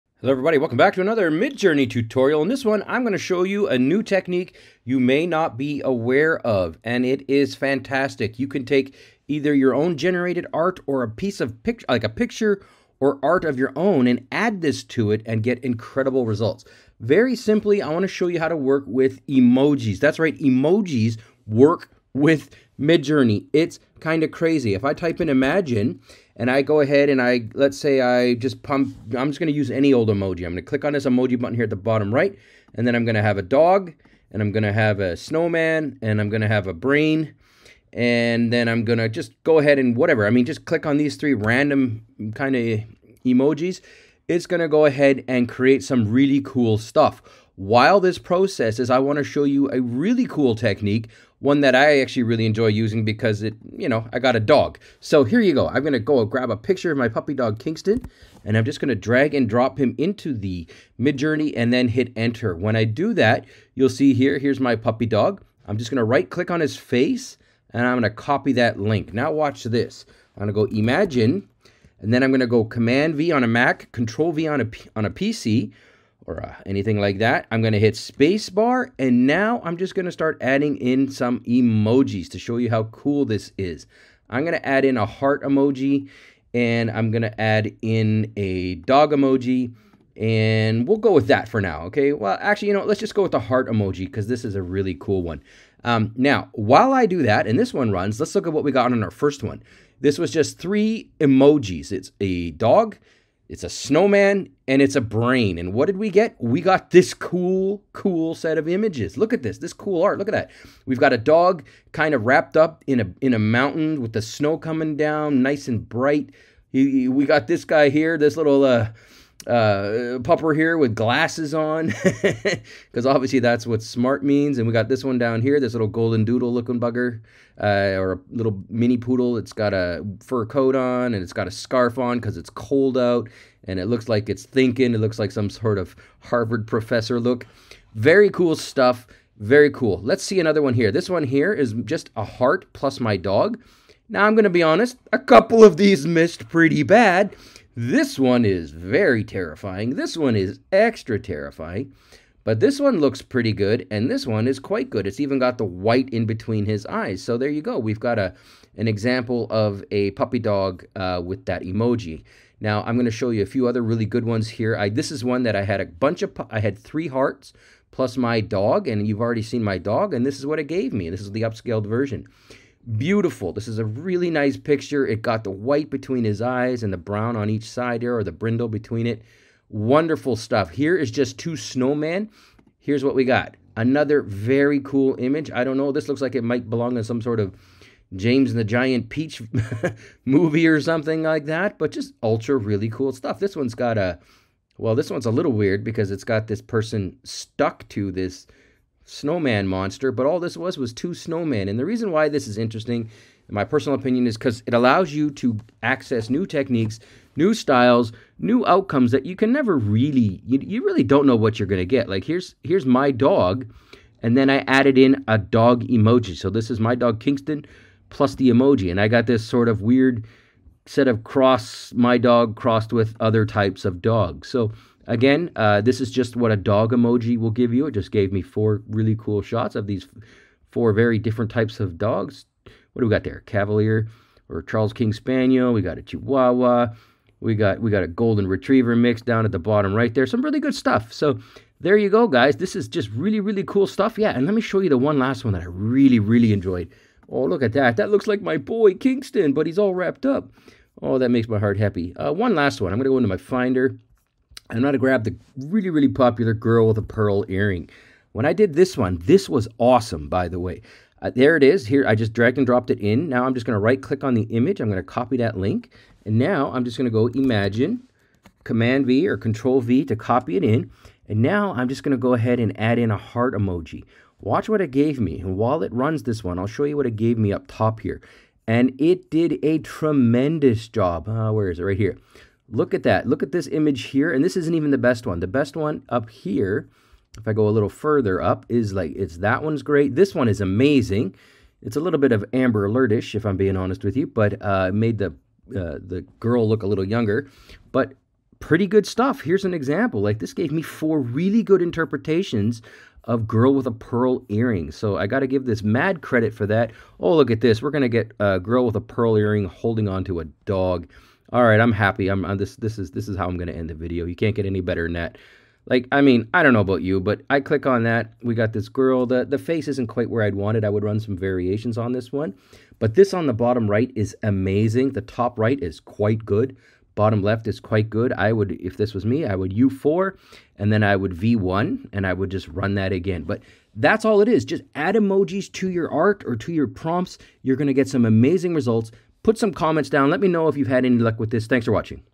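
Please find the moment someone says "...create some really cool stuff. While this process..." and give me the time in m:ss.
0:45.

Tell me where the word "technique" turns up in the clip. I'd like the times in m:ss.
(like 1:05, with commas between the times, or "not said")
0:04, 0:50, 3:26.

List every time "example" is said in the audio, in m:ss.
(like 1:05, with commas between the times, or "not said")
2:38, 4:59.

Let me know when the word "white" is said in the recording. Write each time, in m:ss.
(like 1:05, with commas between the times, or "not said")
2:35, 2:55.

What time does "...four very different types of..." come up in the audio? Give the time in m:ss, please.
3:50.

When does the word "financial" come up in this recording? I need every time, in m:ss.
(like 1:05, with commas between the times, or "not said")
not said.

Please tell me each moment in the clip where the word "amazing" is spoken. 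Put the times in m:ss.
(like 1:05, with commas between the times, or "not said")
4:50, 5:24, 5:38.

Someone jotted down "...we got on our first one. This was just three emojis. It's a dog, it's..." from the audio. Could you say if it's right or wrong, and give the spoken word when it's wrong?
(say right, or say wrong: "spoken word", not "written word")
right.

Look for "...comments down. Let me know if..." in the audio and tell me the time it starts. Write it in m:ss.
5:39.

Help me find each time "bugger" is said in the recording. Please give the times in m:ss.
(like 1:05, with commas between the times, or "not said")
2:06.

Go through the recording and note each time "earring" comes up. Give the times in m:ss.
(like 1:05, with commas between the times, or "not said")
4:17, 5:04, 5:09.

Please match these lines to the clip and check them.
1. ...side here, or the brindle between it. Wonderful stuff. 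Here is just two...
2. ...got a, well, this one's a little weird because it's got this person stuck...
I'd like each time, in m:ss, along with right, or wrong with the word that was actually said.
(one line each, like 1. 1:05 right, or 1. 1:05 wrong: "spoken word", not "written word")
1. 2:57 right
2. 3:13 right.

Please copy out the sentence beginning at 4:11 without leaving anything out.
Oh, that makes my heart happy.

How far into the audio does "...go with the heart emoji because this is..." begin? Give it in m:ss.
1:33.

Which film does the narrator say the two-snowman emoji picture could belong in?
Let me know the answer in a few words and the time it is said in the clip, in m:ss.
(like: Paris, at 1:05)
James and the Giant Peach, at 3:08.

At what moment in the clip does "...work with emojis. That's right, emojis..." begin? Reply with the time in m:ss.
0:18.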